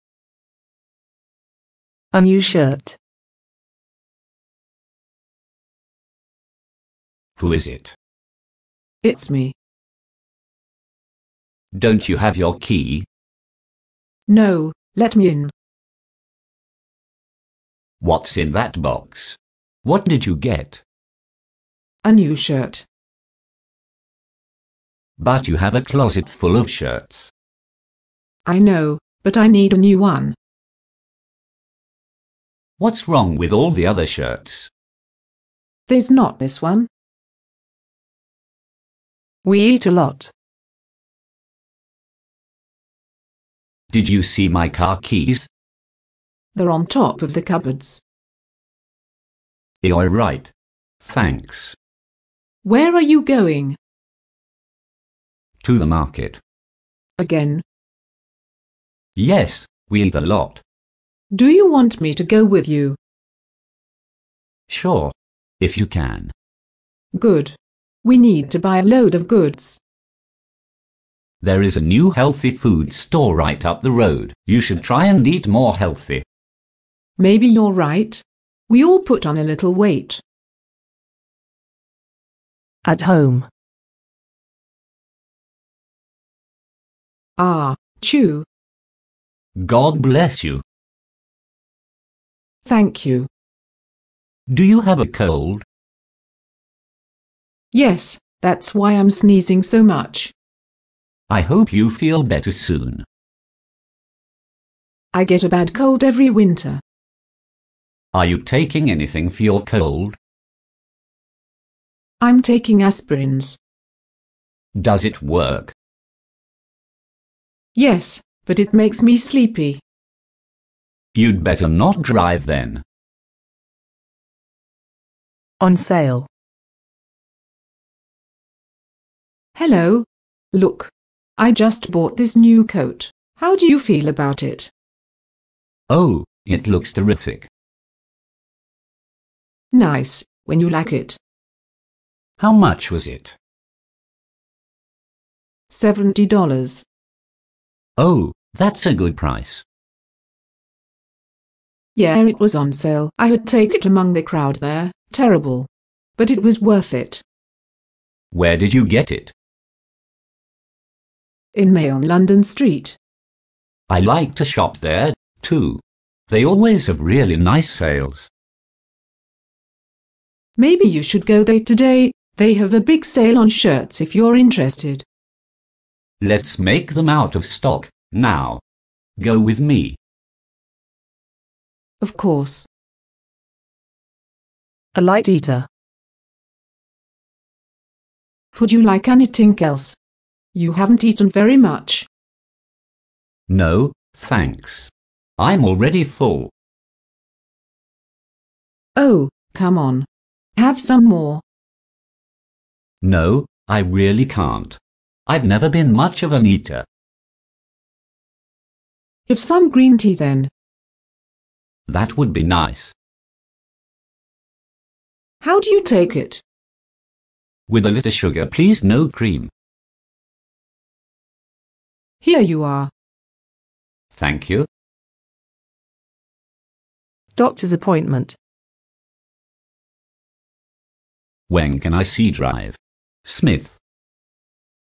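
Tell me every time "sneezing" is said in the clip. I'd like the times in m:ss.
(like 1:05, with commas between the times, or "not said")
1:39.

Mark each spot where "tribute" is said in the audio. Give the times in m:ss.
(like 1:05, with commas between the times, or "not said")
not said.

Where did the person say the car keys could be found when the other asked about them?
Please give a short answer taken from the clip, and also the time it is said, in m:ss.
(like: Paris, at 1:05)
On top of the cupboards, at 0:46.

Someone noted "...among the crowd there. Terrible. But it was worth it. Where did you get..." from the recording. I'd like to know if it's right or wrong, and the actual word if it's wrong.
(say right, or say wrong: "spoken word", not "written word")
right.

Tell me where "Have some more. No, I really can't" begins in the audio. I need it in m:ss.
3:20.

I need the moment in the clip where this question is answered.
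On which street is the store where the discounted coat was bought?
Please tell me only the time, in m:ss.
2:42.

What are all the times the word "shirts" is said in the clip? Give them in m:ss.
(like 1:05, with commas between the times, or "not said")
0:02, 0:22, 0:26, 0:34, 2:53.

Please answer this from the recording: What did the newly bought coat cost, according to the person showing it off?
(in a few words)
$70.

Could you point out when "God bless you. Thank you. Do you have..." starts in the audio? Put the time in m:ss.
1:29.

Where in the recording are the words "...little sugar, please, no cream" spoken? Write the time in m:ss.
3:37.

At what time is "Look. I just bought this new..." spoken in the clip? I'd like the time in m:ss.
2:10.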